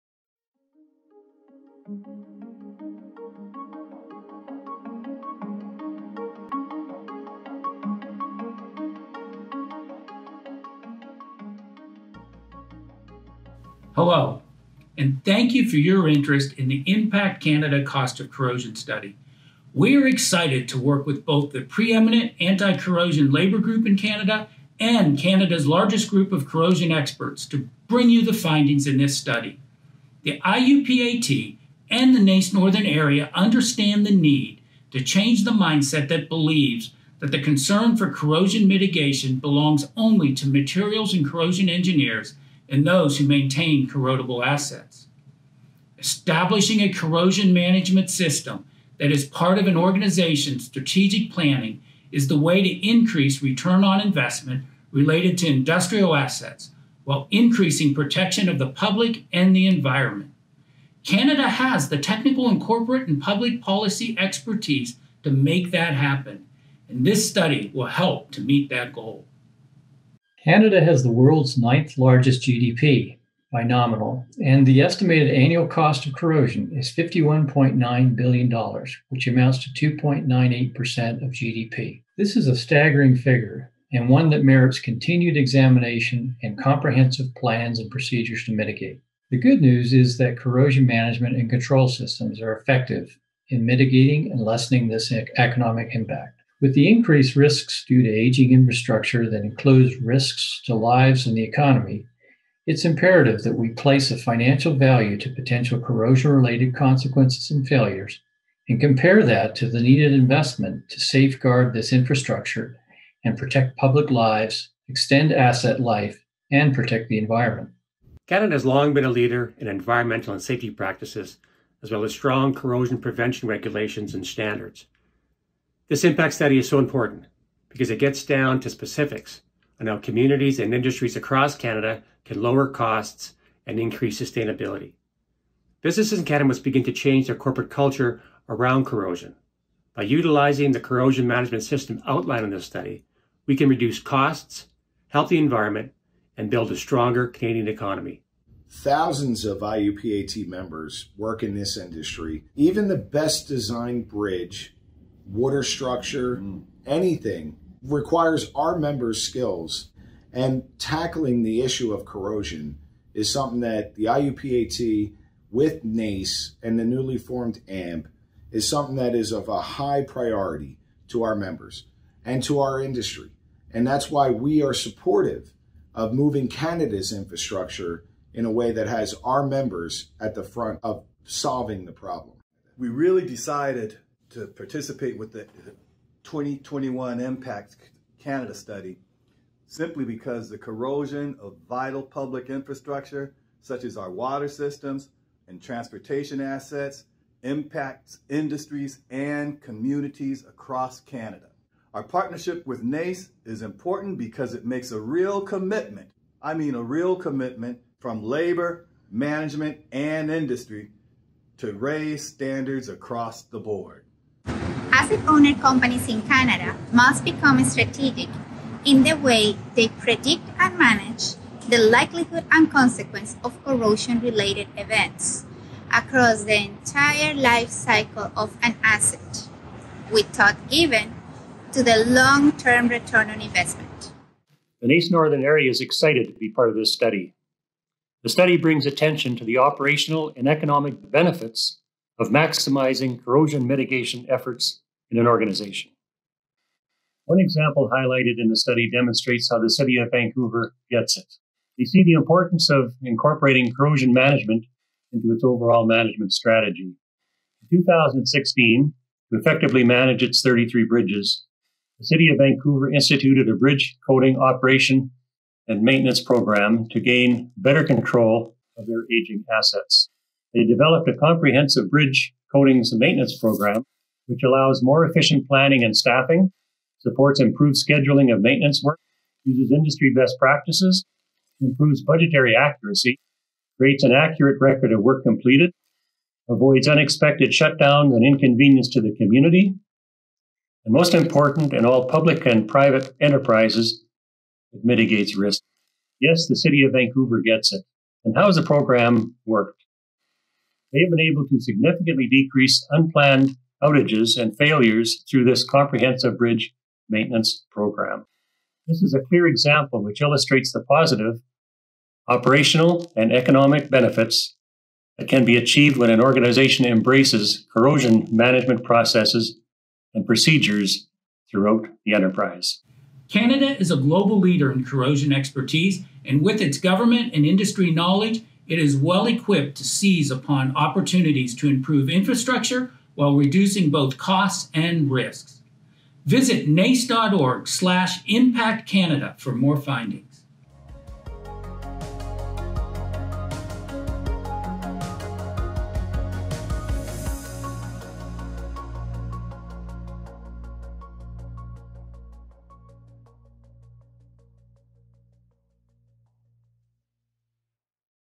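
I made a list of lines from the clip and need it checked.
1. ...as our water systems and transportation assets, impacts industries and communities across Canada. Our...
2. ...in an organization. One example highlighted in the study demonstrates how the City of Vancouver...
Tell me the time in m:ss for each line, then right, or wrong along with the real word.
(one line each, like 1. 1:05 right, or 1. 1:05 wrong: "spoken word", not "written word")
1. 3:13 right
2. 4:05 right.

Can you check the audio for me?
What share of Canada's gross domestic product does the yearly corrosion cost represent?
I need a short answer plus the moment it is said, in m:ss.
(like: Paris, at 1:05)
2.98%, at 1:19.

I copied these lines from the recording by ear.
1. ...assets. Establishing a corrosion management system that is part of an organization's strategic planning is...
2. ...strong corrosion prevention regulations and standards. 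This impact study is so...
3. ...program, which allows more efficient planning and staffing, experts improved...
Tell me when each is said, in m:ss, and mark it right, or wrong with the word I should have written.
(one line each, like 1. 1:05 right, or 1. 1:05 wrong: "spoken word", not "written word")
1. 0:44 right
2. 2:02 right
3. 4:33 wrong: "supports", not "experts".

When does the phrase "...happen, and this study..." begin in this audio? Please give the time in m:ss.
1:05.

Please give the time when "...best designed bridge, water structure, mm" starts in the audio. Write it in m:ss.
2:32.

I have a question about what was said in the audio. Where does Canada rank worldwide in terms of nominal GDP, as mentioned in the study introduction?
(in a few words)
ninth.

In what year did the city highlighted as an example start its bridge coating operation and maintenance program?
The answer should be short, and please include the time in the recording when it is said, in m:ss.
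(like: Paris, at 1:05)
2016, at 4:17.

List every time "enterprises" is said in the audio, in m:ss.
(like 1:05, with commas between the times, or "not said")
4:53, 5:22.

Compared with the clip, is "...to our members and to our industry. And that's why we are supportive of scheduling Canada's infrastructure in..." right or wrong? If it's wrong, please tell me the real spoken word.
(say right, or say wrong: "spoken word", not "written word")
wrong: "moving", not "scheduling".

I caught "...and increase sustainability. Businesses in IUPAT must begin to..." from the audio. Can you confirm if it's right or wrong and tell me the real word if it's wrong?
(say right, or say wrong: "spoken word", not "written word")
wrong: "Canada", not "IUPAT".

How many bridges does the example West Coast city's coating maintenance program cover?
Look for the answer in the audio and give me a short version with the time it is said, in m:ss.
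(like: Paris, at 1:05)
33, at 4:20.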